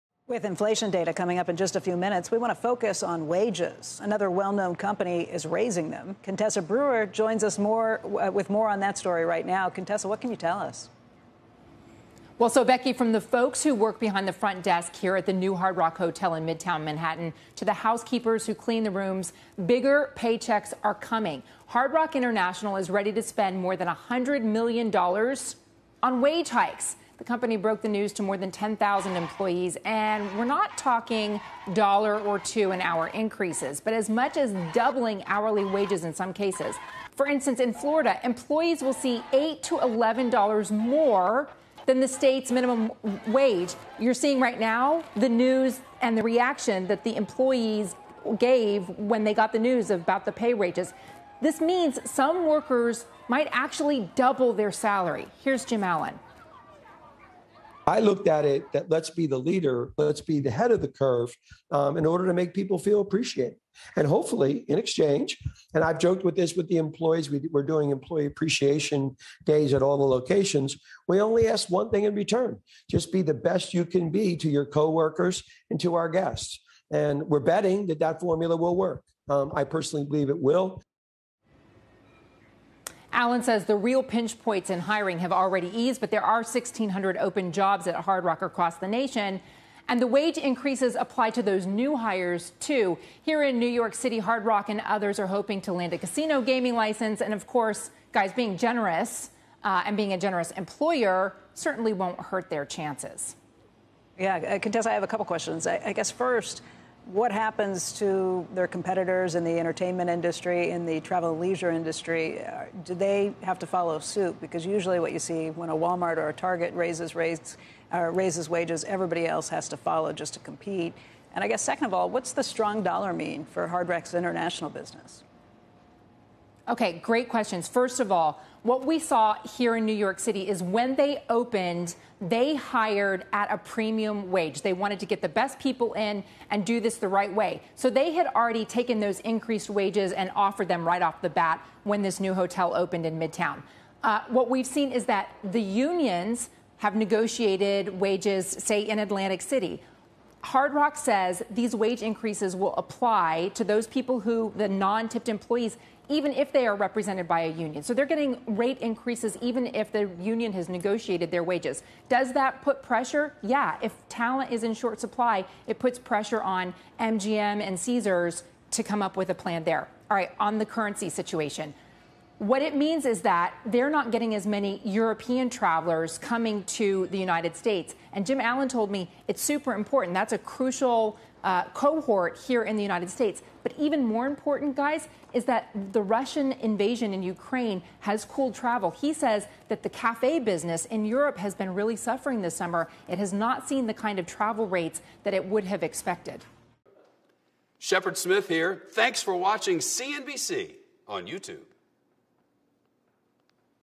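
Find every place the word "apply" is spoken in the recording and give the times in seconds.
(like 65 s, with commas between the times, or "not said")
90 s, 152 s.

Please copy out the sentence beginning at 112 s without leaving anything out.
Uh, do they have to follow suit?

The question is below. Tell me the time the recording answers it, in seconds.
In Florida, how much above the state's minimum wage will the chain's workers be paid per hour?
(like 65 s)
39 s.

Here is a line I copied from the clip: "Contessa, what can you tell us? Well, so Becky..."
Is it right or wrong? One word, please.
right.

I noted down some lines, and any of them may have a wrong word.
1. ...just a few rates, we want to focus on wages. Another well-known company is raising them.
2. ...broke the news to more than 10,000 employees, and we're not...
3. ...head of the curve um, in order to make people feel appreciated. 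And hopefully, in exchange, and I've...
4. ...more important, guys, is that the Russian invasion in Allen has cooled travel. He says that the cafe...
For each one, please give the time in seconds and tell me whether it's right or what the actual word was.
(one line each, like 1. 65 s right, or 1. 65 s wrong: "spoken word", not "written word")
1. 1 s wrong: "minutes", not "rates"
2. 27 s right
3. 60 s right
4. 184 s wrong: "Ukraine", not "Allen".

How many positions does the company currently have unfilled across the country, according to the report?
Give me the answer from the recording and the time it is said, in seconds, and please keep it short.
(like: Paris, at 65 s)
1,600, at 86 s.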